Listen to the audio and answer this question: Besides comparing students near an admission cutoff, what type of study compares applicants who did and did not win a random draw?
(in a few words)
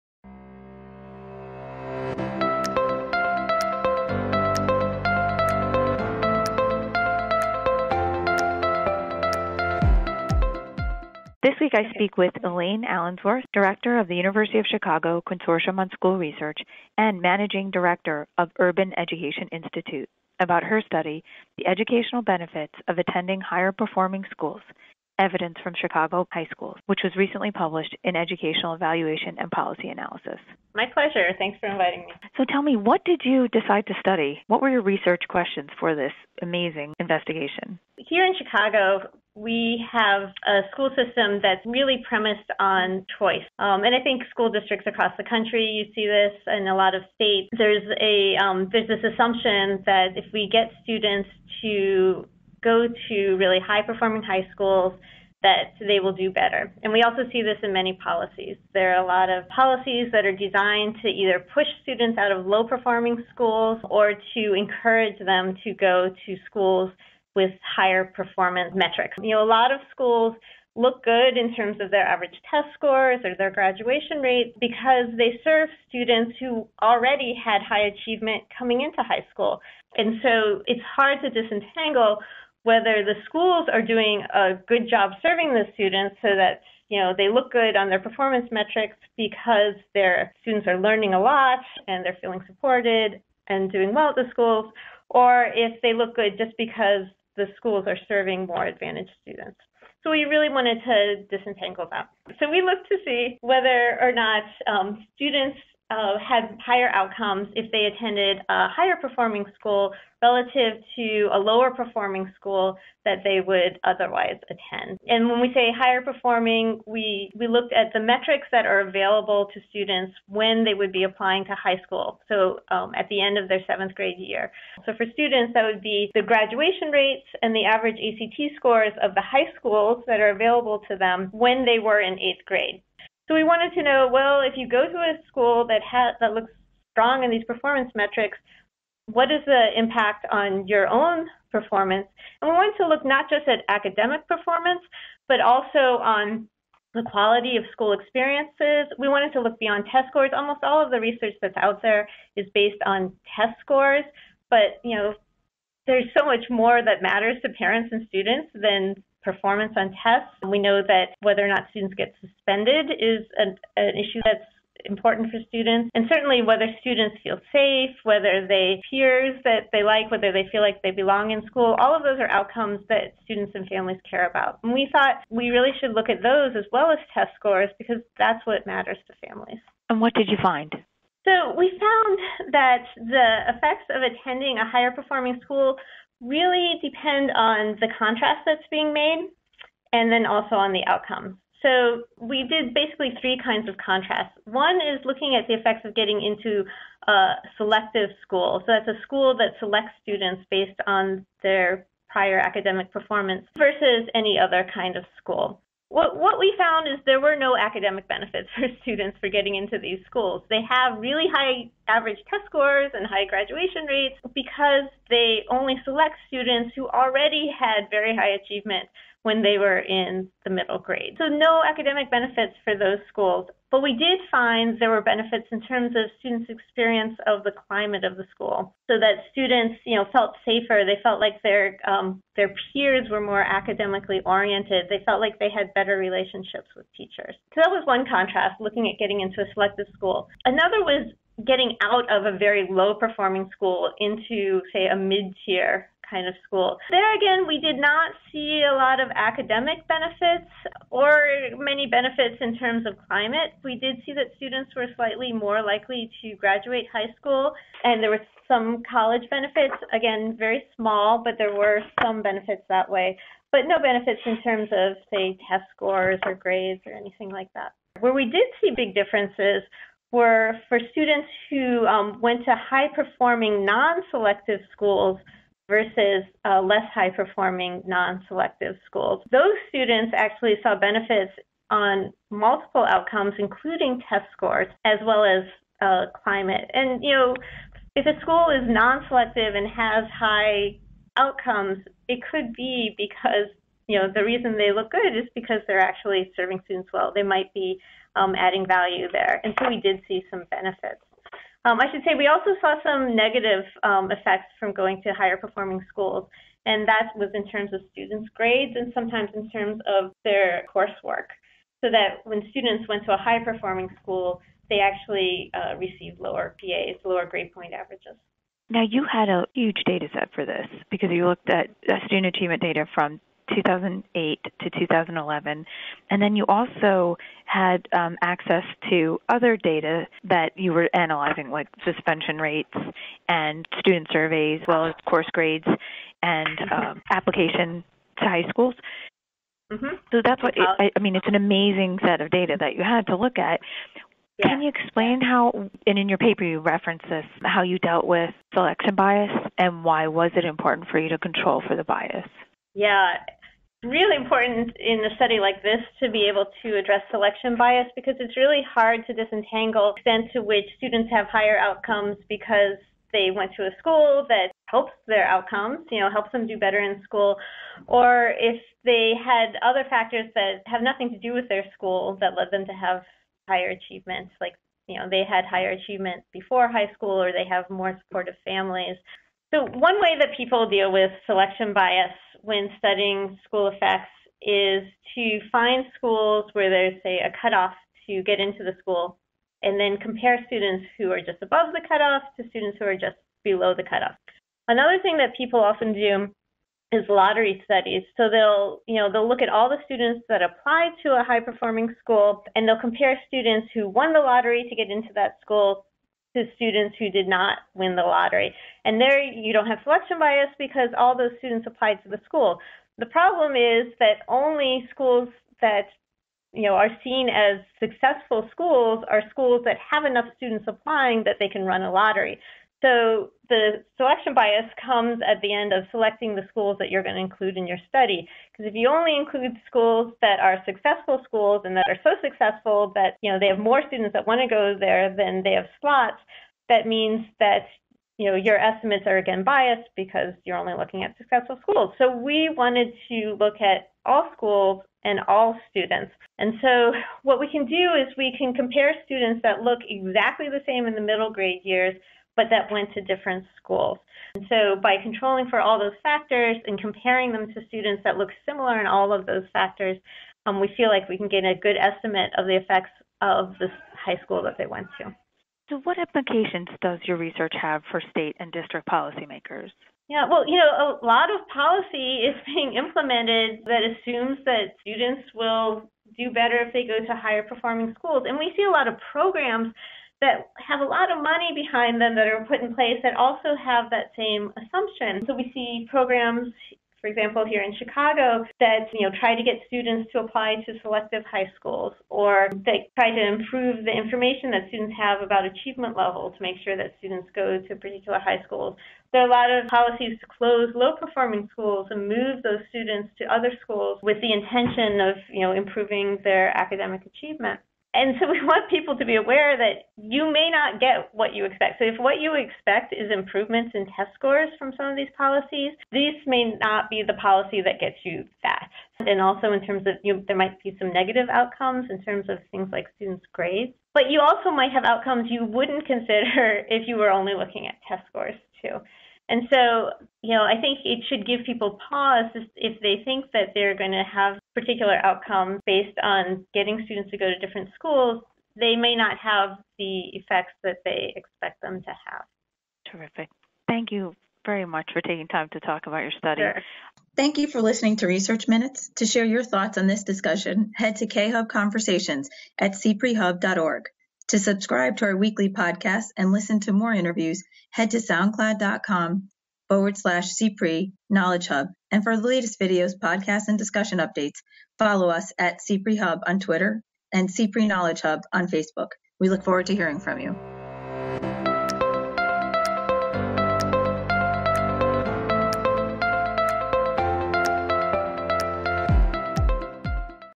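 lottery studies.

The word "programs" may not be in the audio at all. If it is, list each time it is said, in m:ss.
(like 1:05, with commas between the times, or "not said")
7:59, 8:05.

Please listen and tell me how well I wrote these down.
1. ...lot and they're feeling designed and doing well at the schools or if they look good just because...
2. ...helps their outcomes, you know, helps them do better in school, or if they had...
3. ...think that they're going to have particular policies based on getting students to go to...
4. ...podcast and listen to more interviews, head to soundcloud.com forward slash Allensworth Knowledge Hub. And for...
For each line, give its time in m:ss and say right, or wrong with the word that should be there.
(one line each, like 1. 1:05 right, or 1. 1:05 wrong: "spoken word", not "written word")
1. 1:31 wrong: "supported", not "designed"
2. 6:04 right
3. 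8:53 wrong: "outcomes", not "policies"
4. 9:15 wrong: "CPRE", not "Allensworth".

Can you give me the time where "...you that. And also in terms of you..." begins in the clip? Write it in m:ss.
8:38.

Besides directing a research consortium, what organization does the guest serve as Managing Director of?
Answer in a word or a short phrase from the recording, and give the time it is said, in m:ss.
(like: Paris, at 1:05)
Urban Education Institute, at 0:18.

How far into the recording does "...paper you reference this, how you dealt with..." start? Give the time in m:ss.
5:46.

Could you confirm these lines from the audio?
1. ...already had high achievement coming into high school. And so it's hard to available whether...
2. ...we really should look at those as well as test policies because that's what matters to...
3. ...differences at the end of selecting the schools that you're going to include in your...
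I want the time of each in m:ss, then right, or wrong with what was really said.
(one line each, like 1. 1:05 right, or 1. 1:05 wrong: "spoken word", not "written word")
1. 1:16 wrong: "disentangle", not "available"
2. 2:55 wrong: "scores", not "policies"
3. 7:04 wrong: "comes", not "differences".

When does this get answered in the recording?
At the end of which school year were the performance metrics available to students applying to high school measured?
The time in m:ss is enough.
2:03.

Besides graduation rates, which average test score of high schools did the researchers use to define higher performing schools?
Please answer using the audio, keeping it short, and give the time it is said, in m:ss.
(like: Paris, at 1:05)
ACT, at 2:07.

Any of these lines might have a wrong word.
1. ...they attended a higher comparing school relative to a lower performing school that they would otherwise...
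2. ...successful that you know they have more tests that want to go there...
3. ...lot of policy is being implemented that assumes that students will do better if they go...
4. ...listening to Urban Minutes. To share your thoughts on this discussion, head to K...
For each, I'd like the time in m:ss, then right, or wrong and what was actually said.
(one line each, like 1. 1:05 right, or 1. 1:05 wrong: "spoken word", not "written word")
1. 1:47 wrong: "performing", not "comparing"
2. 7:12 wrong: "students", not "tests"
3. 7:51 right
4. 9:07 wrong: "Research", not "Urban".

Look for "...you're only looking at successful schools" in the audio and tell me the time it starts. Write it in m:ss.
7:20.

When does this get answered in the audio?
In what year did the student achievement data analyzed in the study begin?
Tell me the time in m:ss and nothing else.
5:23.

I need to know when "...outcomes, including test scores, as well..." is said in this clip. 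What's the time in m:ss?
4:42.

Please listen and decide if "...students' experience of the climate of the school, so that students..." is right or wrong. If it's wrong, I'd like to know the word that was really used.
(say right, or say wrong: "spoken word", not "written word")
right.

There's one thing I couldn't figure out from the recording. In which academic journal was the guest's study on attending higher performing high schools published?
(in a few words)
Educational Evaluation and Policy Analysis.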